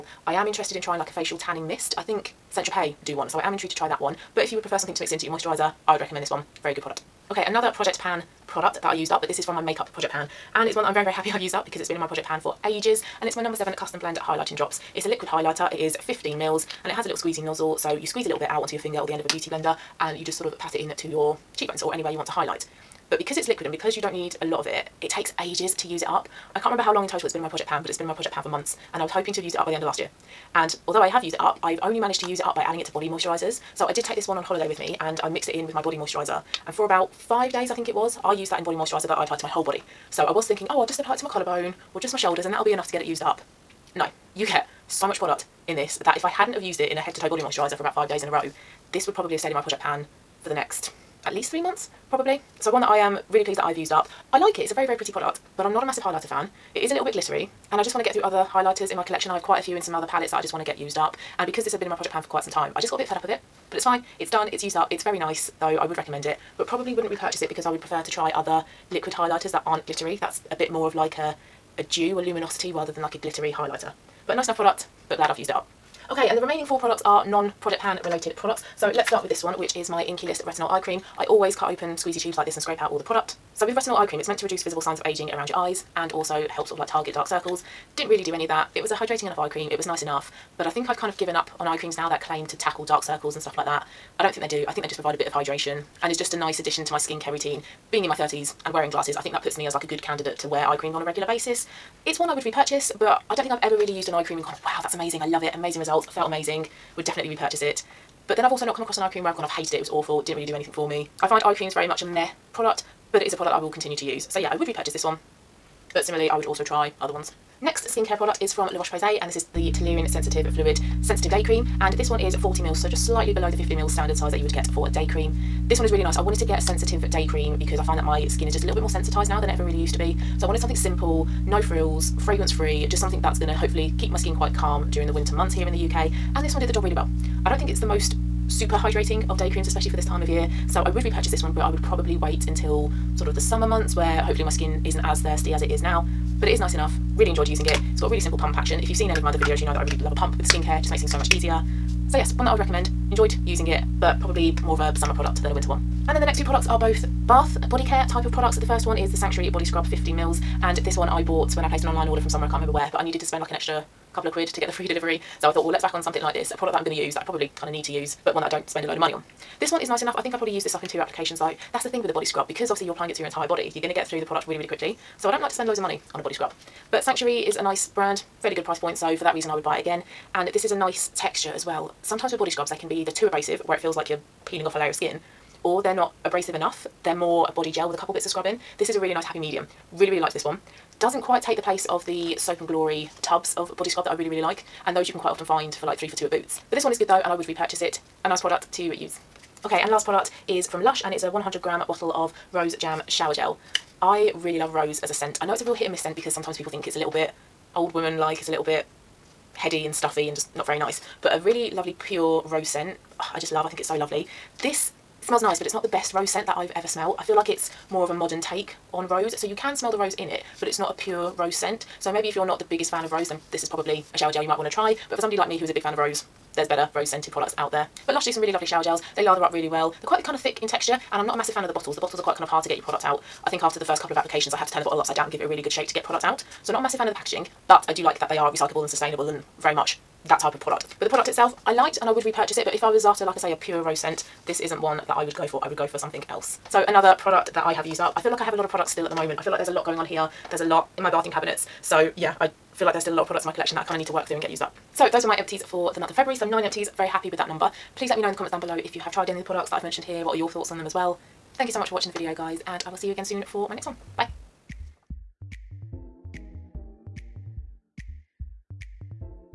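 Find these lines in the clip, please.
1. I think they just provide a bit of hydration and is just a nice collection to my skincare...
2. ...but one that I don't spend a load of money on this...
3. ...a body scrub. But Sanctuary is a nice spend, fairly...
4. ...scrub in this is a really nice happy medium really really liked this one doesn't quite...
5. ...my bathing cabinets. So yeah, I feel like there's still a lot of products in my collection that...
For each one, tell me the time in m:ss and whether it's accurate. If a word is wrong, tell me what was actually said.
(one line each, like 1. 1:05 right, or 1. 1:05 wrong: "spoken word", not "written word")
1. 1:34 wrong: "addition", not "collection"
2. 2:48 right
3. 2:56 wrong: "brand", not "spend"
4. 3:08 right
5. 4:11 right.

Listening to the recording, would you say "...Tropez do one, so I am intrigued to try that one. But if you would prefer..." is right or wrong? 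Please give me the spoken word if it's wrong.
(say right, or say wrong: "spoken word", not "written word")
right.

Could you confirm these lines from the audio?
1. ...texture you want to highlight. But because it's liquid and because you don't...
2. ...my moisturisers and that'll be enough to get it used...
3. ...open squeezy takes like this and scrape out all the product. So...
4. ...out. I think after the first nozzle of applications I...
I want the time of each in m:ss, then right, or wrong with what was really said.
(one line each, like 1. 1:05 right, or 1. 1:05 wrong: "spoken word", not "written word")
1. 0:21 wrong: "anywhere", not "texture"
2. 0:42 wrong: "shoulders", not "moisturisers"
3. 1:21 wrong: "tubes", not "takes"
4. 3:53 wrong: "couple", not "nozzle".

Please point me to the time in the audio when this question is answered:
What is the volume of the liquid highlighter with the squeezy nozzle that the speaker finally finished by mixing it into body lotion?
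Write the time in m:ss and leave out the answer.
0:15.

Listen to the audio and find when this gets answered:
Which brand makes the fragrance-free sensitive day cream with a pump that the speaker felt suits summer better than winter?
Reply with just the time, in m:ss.
1:58.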